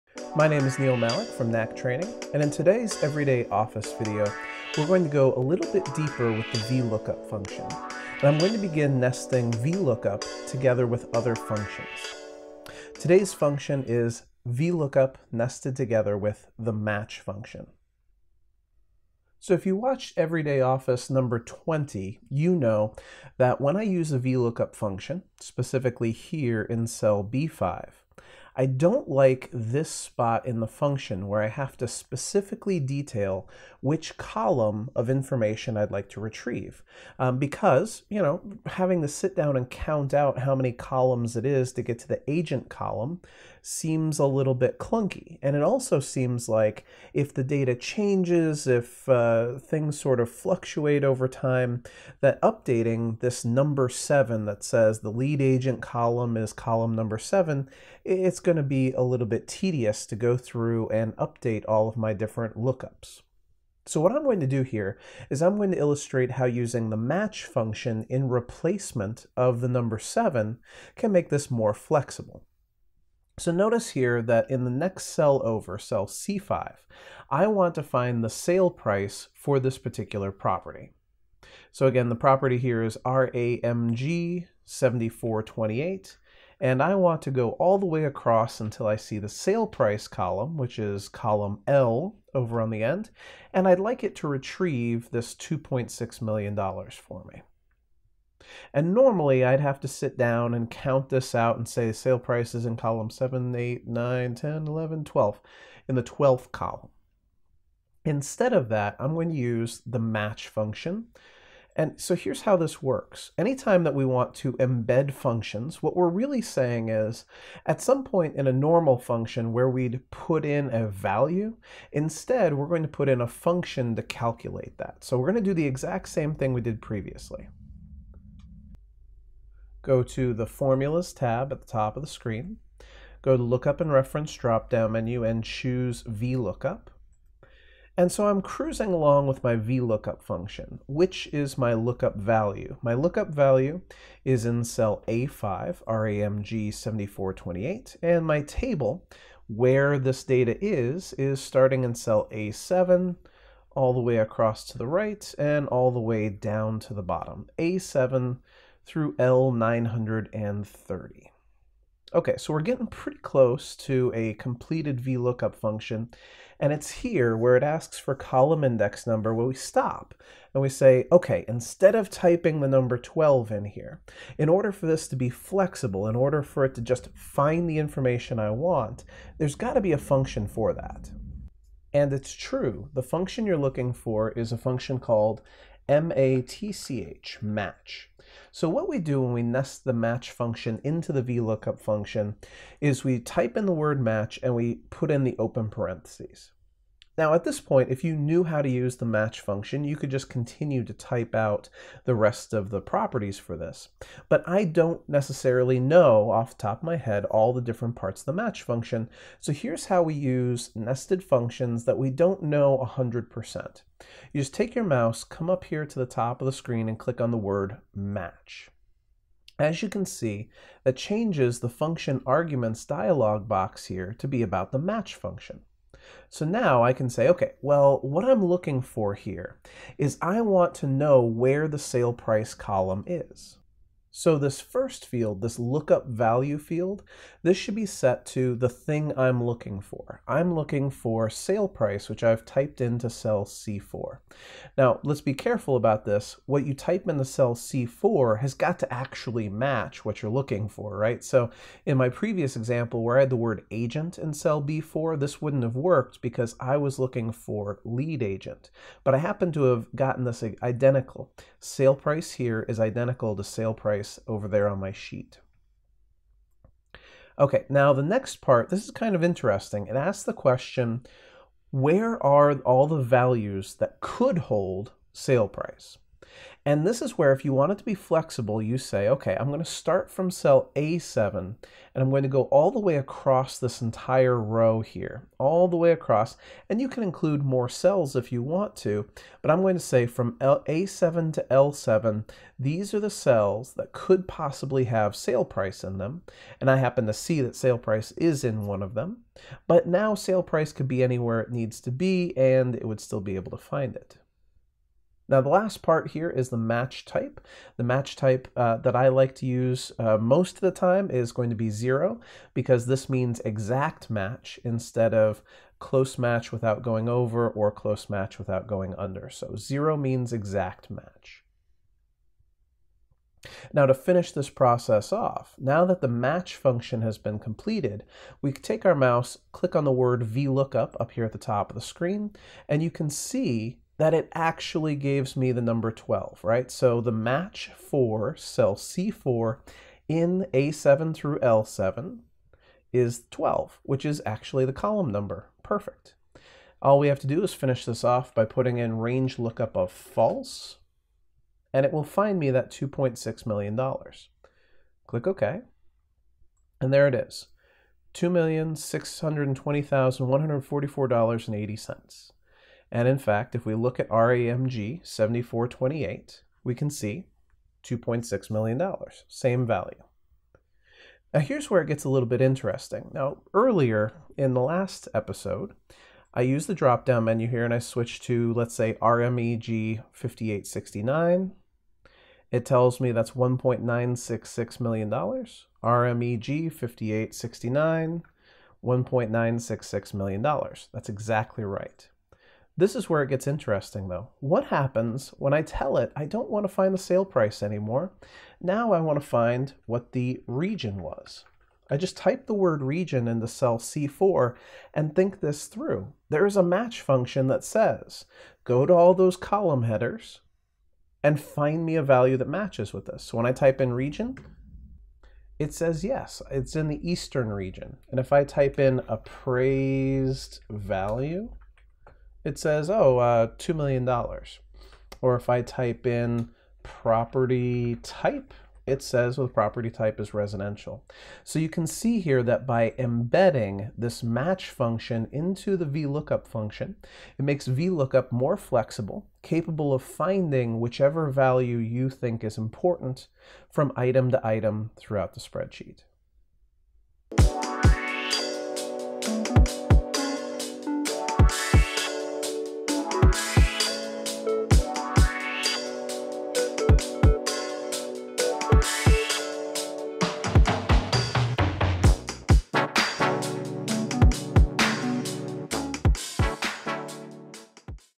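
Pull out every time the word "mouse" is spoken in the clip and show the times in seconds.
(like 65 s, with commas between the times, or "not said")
214 s, 328 s.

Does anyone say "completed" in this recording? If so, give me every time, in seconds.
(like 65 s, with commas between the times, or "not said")
164 s, 327 s.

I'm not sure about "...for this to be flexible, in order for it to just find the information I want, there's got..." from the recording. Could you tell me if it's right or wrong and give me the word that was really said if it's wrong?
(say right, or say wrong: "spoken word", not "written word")
right.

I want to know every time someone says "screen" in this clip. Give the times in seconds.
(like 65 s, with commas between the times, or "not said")
132 s, 216 s, 331 s.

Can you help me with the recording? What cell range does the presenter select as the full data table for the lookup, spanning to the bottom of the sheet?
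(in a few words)
A7 through L930.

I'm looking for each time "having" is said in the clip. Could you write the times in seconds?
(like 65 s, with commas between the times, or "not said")
38 s.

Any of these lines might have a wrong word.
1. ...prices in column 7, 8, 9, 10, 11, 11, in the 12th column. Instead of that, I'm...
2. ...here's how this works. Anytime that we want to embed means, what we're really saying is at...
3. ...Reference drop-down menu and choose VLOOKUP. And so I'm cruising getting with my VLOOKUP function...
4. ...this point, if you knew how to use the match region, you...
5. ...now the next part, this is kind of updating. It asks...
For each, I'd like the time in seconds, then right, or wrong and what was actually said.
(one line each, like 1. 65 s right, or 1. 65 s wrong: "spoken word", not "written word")
1. 102 s wrong: "12", not "11"
2. 112 s wrong: "functions", not "means"
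3. 133 s wrong: "along", not "getting"
4. 197 s wrong: "function", not "region"
5. 267 s wrong: "interesting", not "updating".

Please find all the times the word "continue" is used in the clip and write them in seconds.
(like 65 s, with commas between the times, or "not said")
200 s.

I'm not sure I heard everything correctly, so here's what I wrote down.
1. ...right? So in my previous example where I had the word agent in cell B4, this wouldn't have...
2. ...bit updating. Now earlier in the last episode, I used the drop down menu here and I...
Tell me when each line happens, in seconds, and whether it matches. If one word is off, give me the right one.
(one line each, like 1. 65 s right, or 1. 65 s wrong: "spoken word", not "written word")
1. 250 s right
2. 372 s wrong: "interesting", not "updating".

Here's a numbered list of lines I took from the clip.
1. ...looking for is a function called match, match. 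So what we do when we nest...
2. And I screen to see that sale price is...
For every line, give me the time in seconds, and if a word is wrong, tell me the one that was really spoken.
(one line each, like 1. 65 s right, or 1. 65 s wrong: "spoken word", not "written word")
1. 183 s right
2. 296 s wrong: "happen", not "screen".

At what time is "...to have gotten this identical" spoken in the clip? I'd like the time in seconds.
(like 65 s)
259 s.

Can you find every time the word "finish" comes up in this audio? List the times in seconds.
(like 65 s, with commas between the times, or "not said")
323 s, 347 s.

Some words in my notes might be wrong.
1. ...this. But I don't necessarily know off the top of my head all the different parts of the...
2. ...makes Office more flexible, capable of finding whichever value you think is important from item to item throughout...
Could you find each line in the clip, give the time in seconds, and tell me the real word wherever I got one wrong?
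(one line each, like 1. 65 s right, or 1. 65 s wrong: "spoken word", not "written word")
1. 203 s right
2. 437 s wrong: "VLOOKUP", not "Office".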